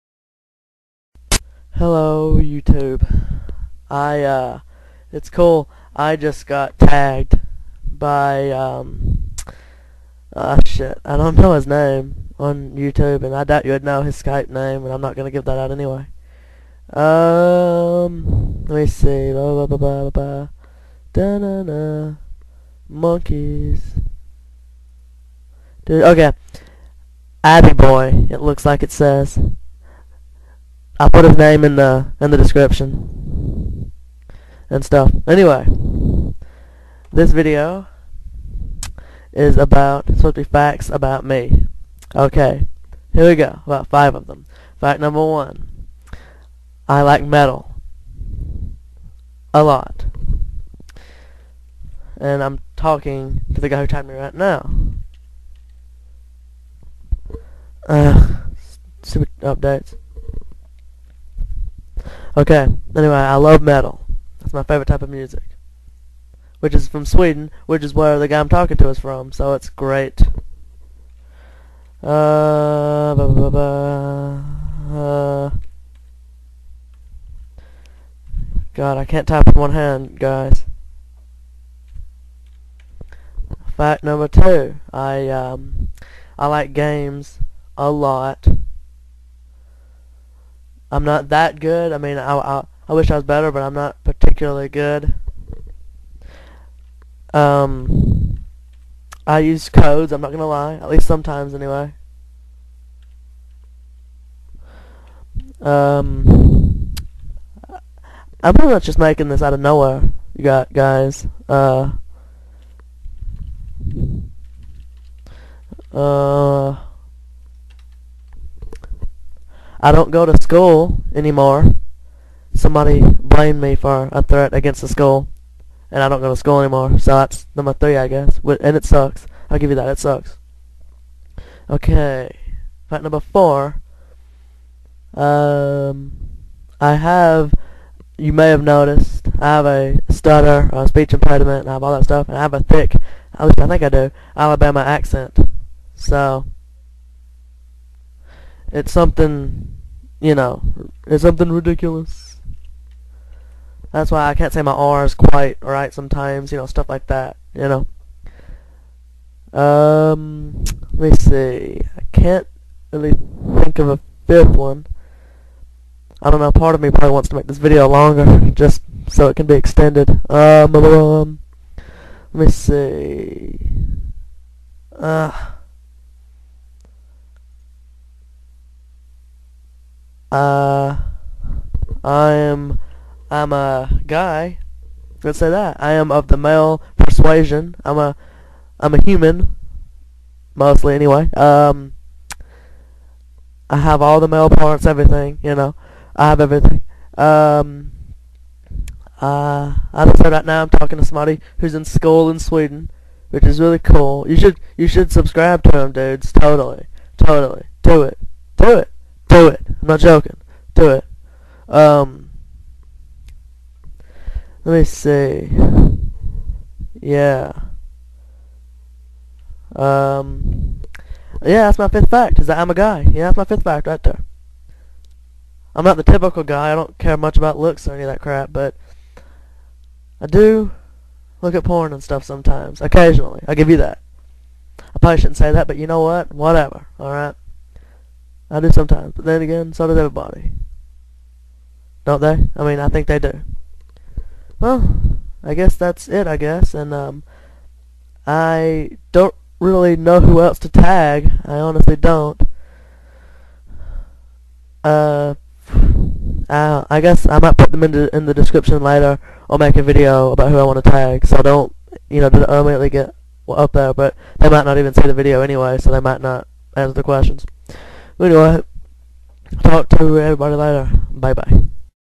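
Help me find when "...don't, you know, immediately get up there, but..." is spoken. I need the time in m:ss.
4:21.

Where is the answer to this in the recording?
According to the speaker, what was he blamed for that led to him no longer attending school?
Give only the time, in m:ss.
2:04.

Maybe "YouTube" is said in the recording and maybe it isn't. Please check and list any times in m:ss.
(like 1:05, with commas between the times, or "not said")
0:02, 0:12.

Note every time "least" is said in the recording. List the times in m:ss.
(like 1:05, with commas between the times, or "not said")
1:40, 2:23.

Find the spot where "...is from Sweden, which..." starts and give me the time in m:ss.
1:06.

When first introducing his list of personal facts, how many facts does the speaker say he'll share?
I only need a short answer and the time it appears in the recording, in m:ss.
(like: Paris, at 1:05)
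5, at 0:43.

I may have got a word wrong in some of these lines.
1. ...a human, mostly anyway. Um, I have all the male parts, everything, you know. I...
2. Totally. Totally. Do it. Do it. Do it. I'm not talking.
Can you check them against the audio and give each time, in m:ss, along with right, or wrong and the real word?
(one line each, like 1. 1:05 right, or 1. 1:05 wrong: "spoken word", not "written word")
1. 3:08 right
2. 3:26 wrong: "joking", not "talking".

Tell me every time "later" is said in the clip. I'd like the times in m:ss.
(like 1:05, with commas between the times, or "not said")
4:18, 4:30.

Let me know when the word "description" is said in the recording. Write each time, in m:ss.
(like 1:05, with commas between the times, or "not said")
0:32, 4:18.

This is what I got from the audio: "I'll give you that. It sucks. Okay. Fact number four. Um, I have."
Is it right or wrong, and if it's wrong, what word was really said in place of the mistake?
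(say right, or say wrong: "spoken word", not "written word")
right.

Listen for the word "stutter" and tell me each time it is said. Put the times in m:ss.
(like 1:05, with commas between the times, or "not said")
2:20.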